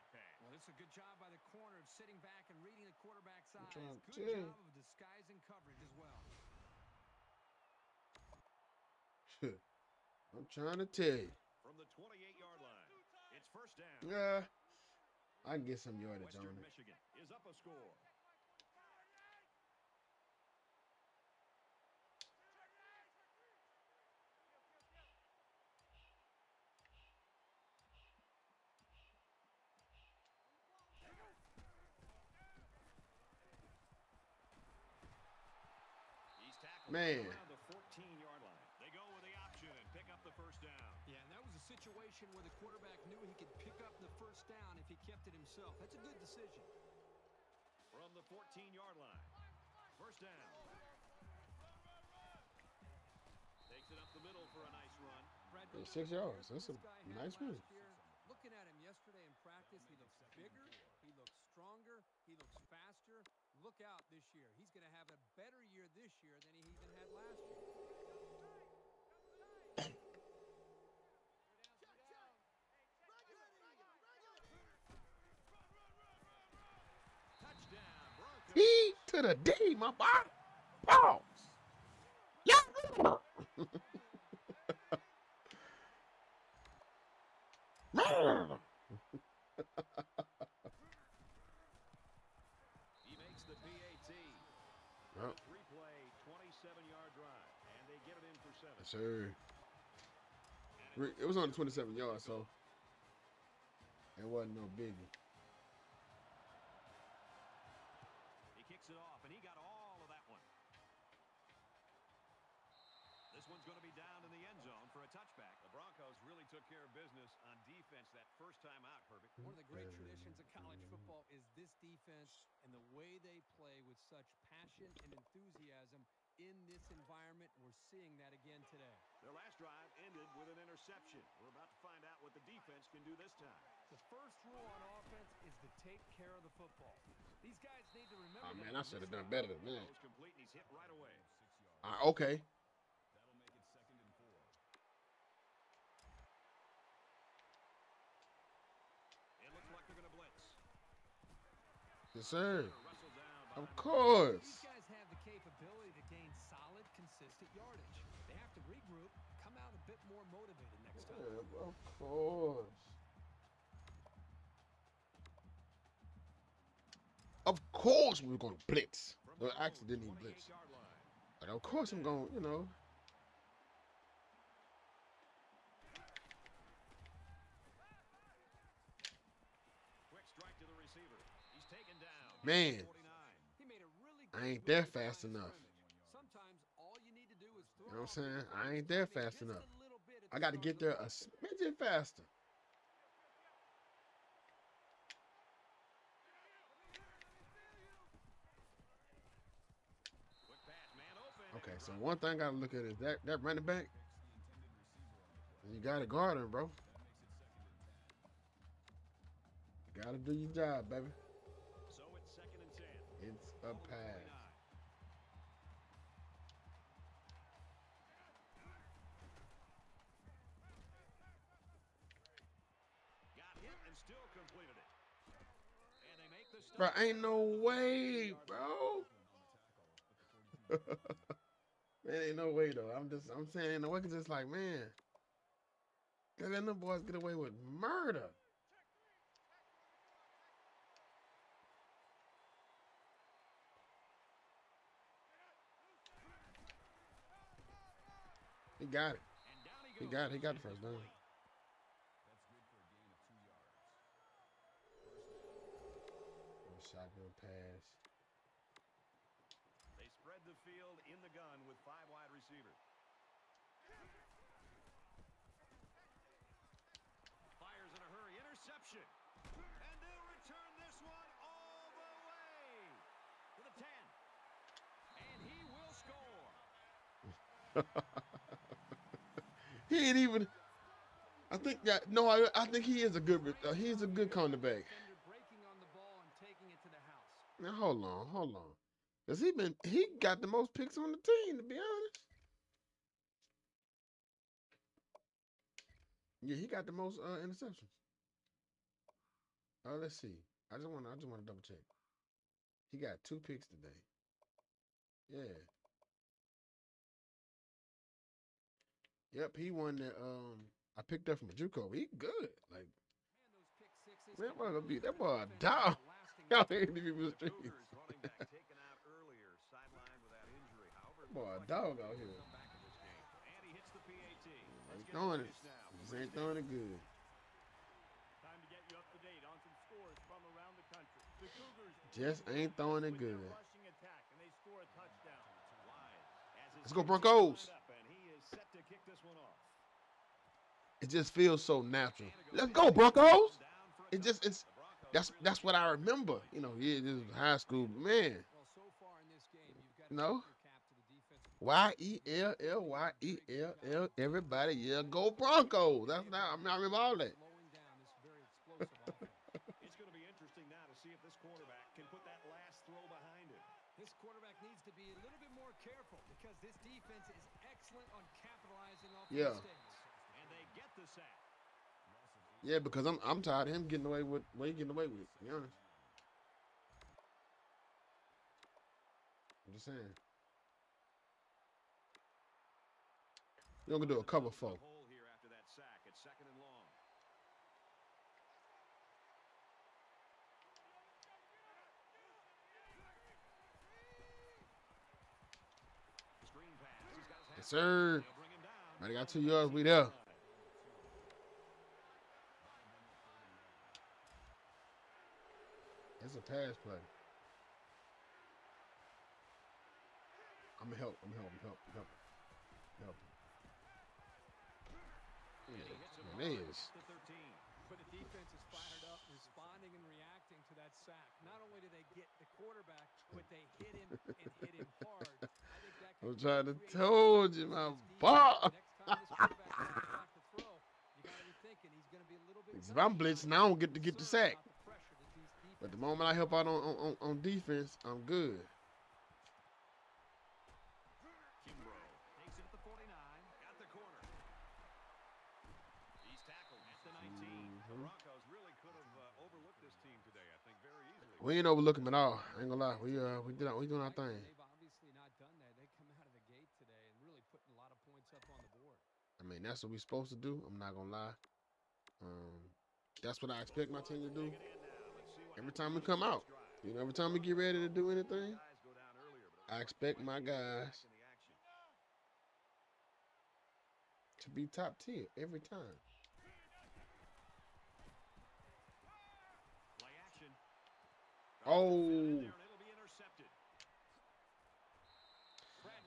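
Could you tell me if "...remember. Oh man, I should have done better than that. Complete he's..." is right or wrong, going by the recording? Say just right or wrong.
right.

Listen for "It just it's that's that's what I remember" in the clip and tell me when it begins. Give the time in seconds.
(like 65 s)
344 s.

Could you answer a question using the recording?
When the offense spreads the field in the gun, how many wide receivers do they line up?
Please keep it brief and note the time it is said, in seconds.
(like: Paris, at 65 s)
5, at 261 s.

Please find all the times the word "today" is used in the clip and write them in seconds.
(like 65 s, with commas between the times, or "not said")
128 s, 303 s.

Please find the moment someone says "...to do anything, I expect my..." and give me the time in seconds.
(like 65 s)
467 s.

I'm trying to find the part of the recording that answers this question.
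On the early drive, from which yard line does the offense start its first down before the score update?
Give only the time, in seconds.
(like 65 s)
11 s.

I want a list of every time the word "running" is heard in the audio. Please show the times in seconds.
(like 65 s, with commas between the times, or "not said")
203 s.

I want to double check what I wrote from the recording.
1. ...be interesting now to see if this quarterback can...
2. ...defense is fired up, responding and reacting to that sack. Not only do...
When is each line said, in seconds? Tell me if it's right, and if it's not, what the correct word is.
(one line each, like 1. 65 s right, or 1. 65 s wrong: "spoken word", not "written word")
1. 360 s right
2. 418 s right.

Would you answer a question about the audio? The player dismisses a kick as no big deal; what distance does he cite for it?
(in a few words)
27 yards.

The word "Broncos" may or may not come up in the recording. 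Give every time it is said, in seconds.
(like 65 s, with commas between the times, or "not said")
115 s, 337 s, 342 s, 355 s.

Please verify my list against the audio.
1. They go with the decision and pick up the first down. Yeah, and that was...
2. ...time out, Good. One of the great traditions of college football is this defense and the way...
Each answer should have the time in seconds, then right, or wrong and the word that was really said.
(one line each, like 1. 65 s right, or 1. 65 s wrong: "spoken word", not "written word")
1. 37 s wrong: "option", not "decision"
2. 118 s wrong: "Perfect", not "Good".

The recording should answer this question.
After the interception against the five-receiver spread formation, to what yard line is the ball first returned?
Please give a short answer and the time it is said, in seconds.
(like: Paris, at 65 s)
10, at 273 s.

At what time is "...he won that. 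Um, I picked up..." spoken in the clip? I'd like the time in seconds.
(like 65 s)
309 s.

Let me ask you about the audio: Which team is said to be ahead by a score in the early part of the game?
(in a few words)
Michigan.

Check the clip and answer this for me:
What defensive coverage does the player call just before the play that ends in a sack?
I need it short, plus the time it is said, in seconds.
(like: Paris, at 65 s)
Cover four, at 384 s.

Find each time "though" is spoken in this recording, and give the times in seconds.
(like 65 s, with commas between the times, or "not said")
232 s.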